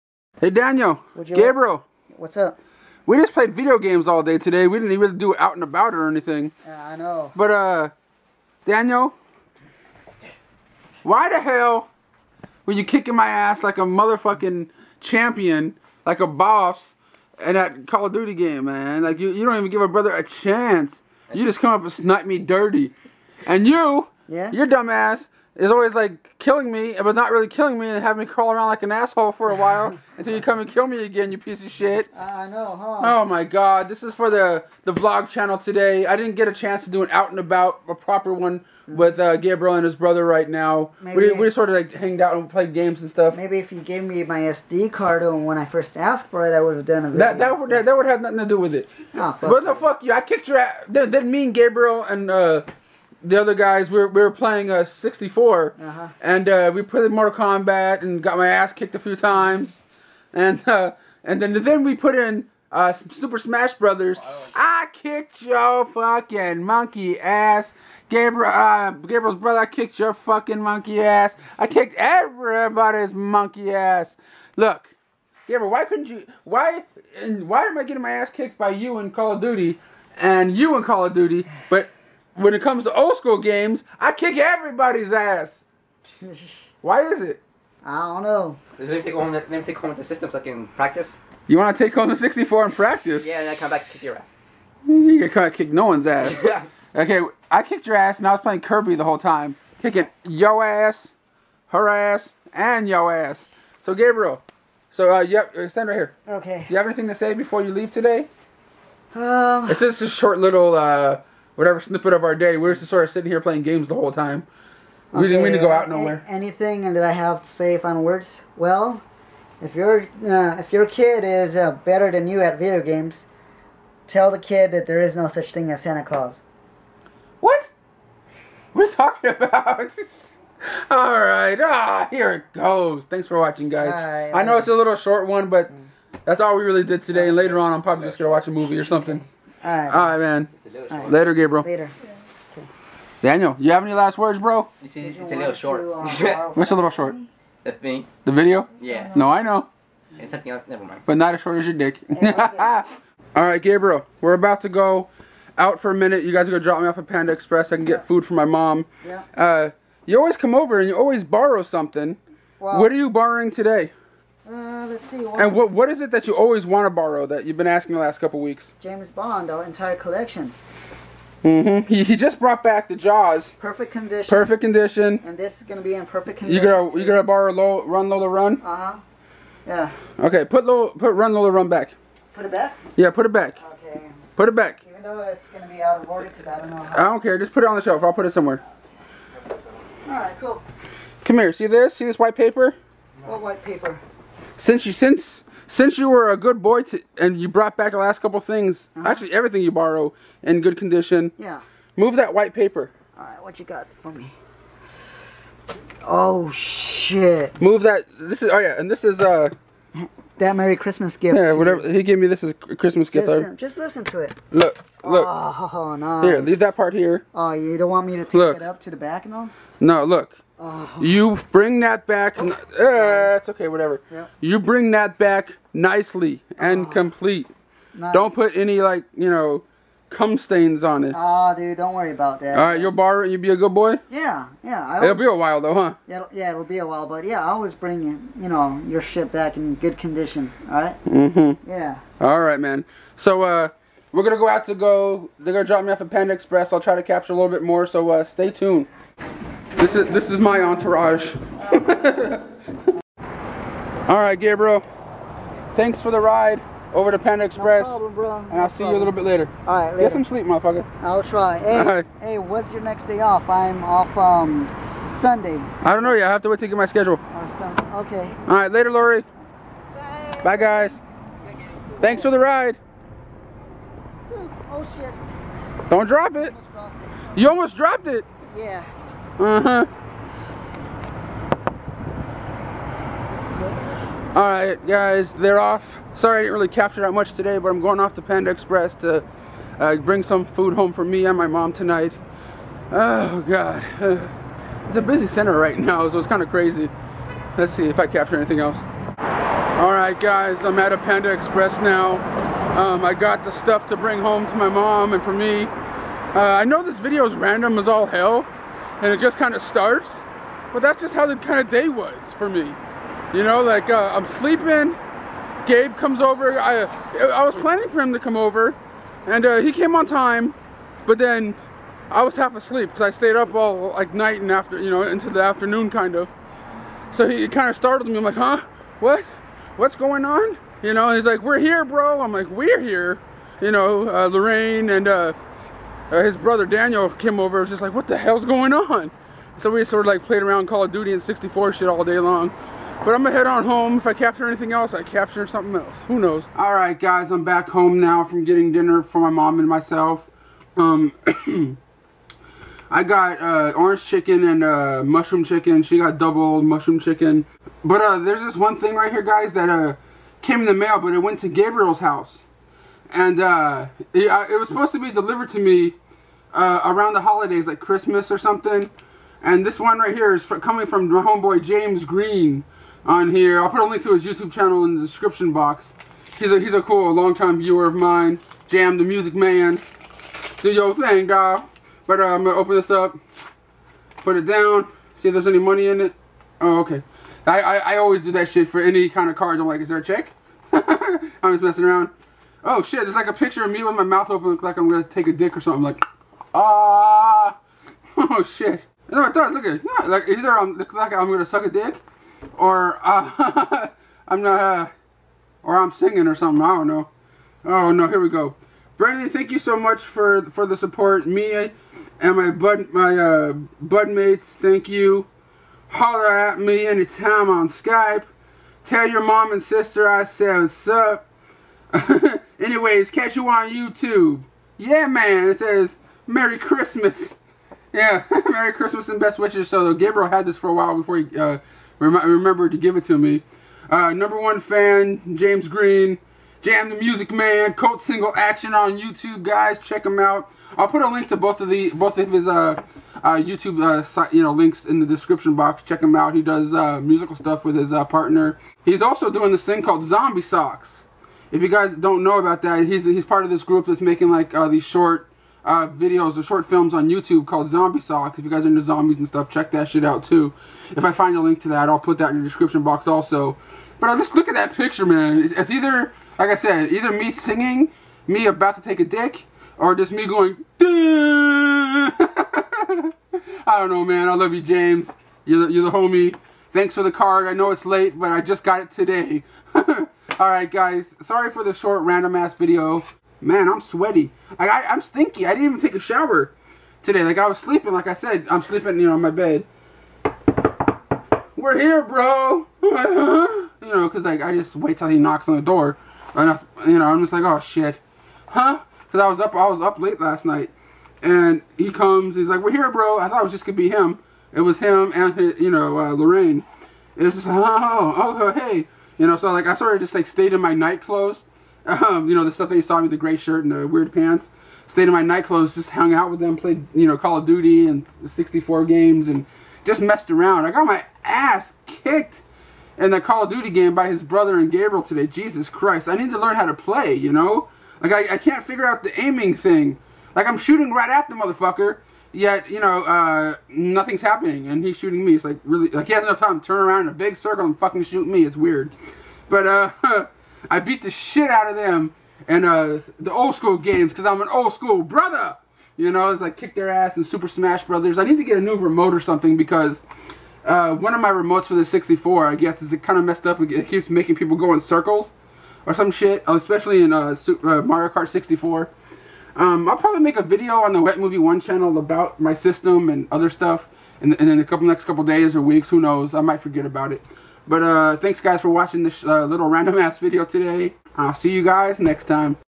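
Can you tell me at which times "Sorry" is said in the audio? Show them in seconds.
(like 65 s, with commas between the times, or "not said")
286 s, 481 s.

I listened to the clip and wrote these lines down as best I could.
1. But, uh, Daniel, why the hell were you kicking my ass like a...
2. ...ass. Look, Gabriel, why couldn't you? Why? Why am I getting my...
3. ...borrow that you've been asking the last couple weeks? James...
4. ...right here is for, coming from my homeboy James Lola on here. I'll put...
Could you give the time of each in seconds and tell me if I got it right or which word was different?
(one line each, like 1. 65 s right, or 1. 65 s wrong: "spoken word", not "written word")
1. 7 s right
2. 73 s right
3. 166 s right
4. 369 s wrong: "Green", not "Lola".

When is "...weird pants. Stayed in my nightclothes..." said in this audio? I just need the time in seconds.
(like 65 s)
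513 s.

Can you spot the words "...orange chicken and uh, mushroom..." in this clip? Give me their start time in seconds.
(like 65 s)
353 s.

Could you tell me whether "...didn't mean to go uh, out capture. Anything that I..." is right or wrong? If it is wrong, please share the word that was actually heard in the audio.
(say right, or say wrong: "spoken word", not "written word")
wrong: "nowhere", not "capture".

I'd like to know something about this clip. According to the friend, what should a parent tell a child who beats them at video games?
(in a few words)
No such thing as Santa Claus.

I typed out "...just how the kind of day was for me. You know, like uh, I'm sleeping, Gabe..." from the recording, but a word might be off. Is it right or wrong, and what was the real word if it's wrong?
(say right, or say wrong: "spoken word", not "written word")
right.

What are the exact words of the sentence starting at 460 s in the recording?
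If I find a link to that, I'll put that in the description box also.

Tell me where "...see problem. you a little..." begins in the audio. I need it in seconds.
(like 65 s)
258 s.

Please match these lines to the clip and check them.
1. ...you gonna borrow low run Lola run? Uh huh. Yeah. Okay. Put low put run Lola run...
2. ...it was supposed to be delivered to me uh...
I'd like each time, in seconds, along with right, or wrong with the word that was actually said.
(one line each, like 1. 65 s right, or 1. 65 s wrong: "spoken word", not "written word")
1. 176 s right
2. 364 s right.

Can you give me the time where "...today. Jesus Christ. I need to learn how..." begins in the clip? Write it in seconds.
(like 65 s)
525 s.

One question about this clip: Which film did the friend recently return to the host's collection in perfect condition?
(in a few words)
Jaws.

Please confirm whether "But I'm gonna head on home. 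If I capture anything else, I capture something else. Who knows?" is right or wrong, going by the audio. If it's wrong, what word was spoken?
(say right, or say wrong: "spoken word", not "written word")
right.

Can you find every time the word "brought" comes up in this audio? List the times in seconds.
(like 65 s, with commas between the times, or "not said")
172 s, 197 s.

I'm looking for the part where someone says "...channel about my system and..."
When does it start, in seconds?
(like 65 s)
561 s.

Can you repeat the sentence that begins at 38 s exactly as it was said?
with uh, Gabriel and his brother right now.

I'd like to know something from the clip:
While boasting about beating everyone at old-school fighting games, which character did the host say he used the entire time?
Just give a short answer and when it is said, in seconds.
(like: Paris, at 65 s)
Kirby, at 98 s.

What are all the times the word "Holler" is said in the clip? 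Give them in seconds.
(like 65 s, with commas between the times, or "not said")
415 s.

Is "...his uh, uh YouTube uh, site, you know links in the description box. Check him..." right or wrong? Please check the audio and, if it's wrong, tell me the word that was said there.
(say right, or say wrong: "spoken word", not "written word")
right.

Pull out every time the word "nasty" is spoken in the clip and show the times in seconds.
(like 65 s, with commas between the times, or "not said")
not said.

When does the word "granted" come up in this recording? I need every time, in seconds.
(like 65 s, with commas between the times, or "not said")
not said.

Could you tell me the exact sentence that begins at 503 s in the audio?
I thought it was just going to be him.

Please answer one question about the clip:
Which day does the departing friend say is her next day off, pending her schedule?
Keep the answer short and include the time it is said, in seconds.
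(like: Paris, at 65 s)
Sunday, at 264 s.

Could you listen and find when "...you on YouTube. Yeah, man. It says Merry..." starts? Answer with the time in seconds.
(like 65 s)
423 s.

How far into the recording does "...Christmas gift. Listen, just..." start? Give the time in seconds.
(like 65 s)
212 s.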